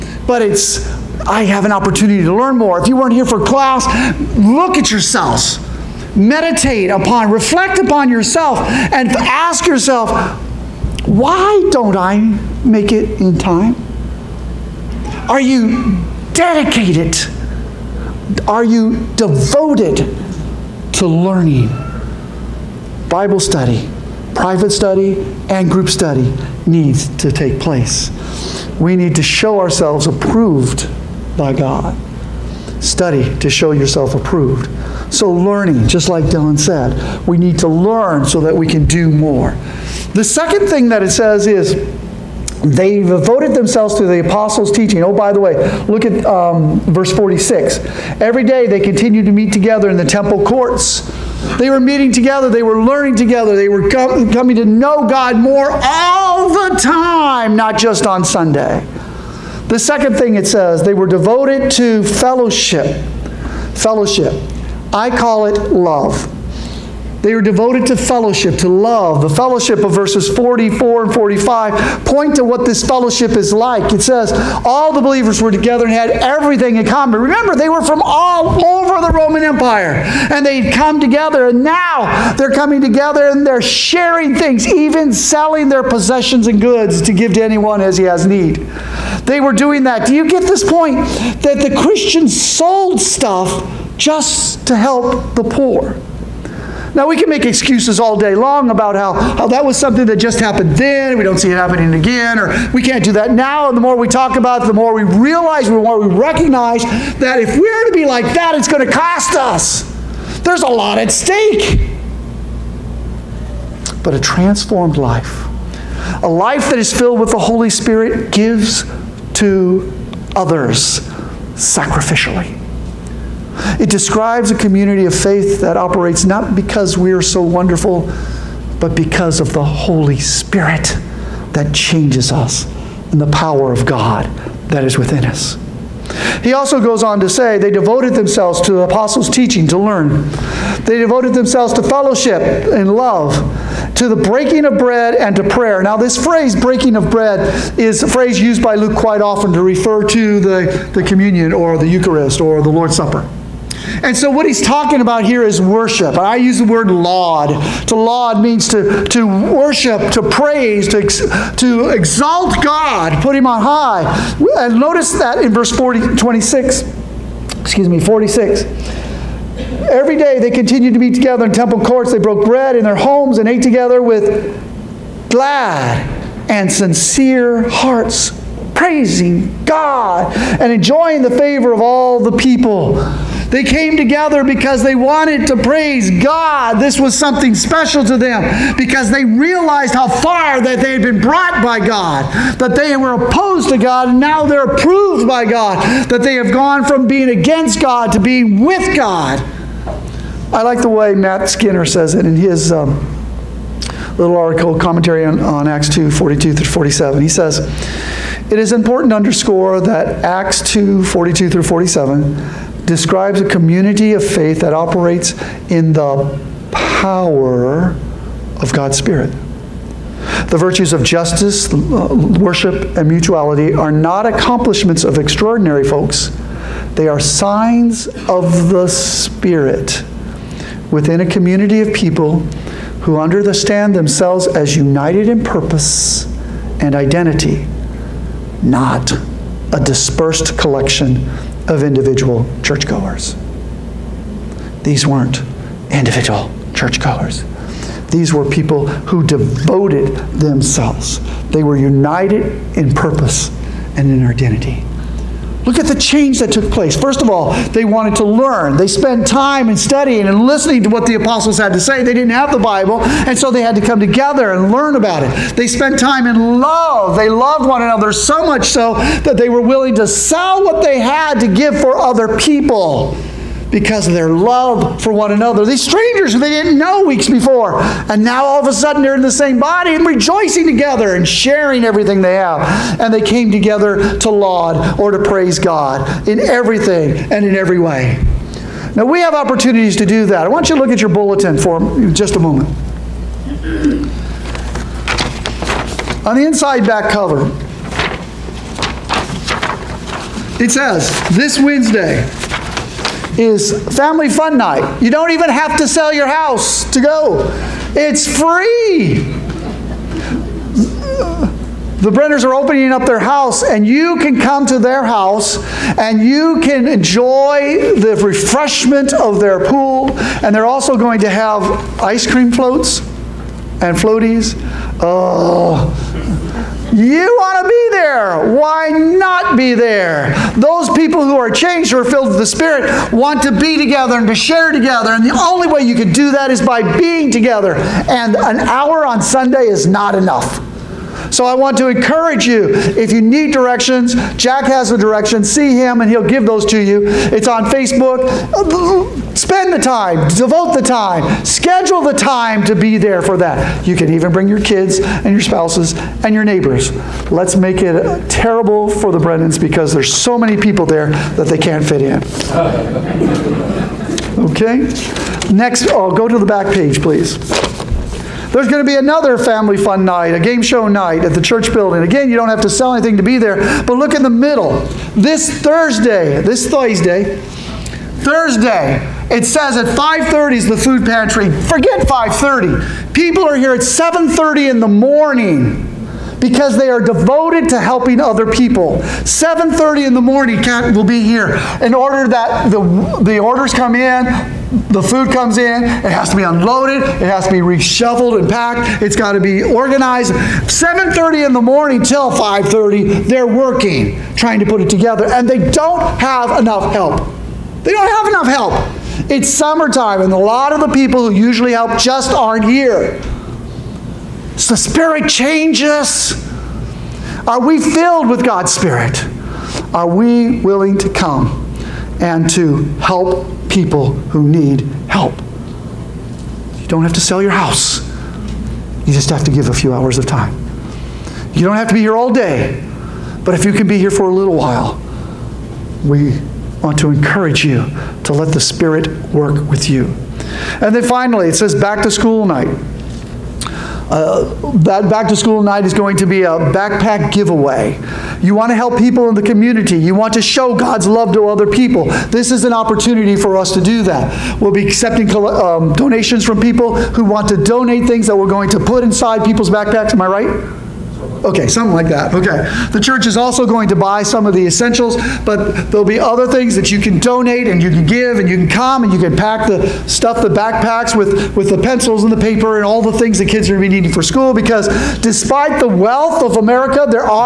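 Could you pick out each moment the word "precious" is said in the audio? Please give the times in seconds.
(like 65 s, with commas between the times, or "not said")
not said.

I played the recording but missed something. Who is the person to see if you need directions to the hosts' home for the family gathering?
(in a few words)
Jack.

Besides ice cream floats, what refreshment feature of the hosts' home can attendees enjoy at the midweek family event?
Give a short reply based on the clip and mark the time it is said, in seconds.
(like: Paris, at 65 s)
Their pool, at 319 s.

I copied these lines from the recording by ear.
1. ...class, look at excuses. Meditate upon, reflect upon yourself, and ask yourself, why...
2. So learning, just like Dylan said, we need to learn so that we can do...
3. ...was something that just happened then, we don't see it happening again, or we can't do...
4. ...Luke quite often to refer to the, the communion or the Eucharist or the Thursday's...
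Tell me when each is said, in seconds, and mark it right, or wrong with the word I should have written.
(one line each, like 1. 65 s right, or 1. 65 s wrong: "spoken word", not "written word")
1. 3 s wrong: "yourselves", not "excuses"
2. 35 s right
3. 99 s right
4. 148 s wrong: "Lord", not "Thursday".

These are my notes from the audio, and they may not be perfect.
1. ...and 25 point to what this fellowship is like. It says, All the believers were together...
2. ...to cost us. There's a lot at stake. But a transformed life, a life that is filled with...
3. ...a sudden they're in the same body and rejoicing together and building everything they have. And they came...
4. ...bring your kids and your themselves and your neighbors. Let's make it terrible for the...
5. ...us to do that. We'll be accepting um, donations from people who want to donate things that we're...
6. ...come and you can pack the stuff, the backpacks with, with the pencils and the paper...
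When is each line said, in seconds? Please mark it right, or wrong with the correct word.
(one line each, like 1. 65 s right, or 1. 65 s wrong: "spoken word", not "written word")
1. 71 s wrong: "45", not "25"
2. 108 s right
3. 278 s wrong: "sharing", not "building"
4. 354 s wrong: "spouses", not "themselves"
5. 453 s right
6. 468 s right.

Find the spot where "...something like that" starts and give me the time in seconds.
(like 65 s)
461 s.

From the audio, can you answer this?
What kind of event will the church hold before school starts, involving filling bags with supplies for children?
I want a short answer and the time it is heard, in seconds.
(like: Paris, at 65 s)
Backpack giveaway, at 446 s.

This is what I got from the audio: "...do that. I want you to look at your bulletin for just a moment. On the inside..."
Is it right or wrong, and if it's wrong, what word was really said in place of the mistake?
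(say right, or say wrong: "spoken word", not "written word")
right.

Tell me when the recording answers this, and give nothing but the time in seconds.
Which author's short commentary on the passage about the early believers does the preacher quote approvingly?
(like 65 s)
201 s.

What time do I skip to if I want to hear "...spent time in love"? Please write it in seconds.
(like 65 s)
265 s.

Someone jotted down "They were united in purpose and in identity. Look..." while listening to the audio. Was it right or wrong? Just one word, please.
right.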